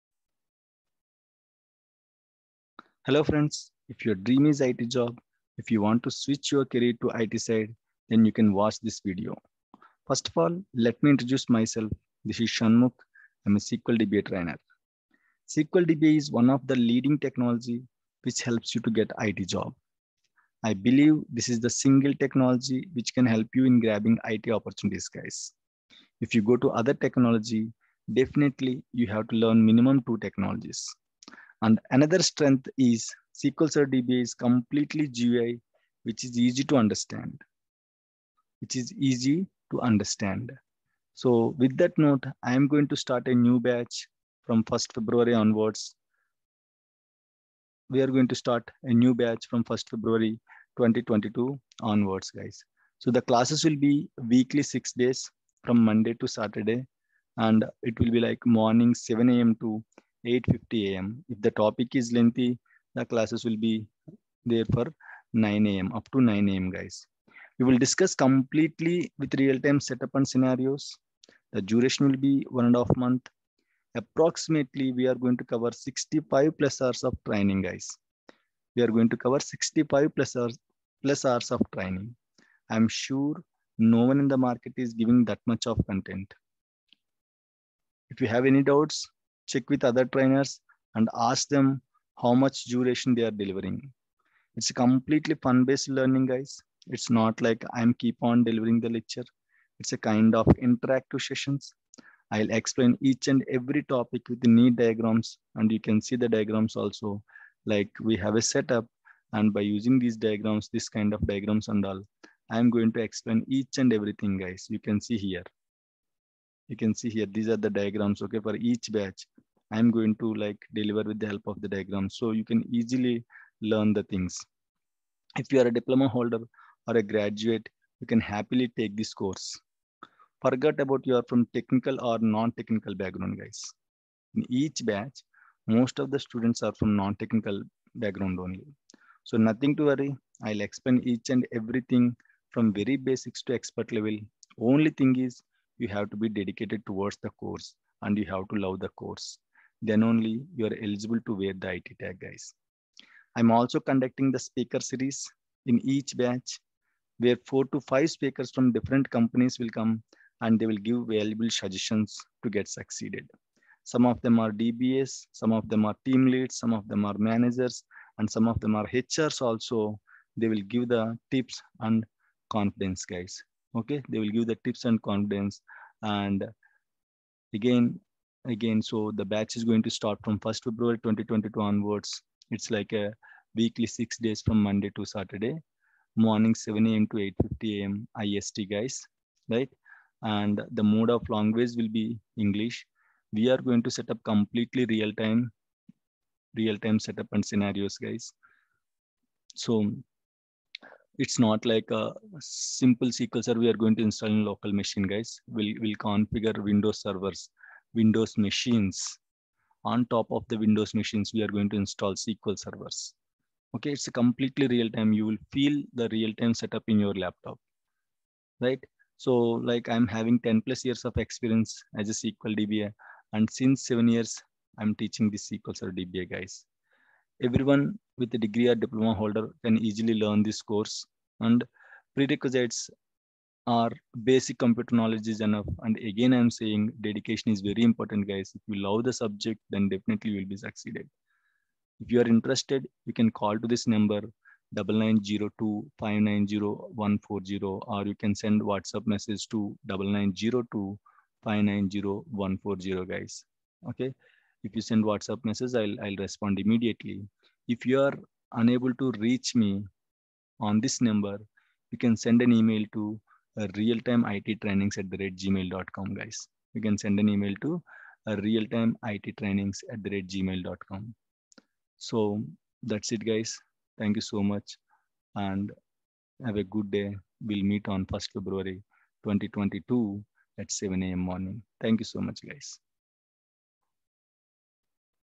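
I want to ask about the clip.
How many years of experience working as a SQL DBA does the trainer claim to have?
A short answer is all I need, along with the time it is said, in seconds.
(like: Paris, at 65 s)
10+ years, at 220 s.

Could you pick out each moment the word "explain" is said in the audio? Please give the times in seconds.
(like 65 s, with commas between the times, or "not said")
102 s, 113 s, 140 s.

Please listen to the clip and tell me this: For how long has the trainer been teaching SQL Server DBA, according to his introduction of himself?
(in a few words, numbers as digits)
7 years.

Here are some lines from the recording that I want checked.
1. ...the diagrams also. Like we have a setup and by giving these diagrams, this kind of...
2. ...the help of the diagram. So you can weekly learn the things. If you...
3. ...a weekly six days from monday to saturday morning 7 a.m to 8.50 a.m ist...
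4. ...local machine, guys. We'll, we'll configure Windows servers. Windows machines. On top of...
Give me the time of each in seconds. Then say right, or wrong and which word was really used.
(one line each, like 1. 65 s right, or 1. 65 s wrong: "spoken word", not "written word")
1. 106 s wrong: "using", not "giving"
2. 121 s wrong: "easily", not "weekly"
3. 182 s right
4. 204 s right.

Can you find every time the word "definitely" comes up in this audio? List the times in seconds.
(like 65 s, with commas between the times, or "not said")
28 s, 239 s.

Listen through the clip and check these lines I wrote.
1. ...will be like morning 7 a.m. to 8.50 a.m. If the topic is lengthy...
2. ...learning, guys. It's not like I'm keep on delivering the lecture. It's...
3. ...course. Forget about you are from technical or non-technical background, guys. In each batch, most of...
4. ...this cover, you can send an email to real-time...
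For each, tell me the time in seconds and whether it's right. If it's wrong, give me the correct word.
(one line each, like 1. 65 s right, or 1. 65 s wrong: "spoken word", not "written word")
1. 57 s right
2. 95 s right
3. 129 s right
4. 260 s wrong: "number", not "cover".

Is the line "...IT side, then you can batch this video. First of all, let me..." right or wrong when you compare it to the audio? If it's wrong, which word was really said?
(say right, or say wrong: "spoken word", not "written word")
wrong: "watch", not "batch".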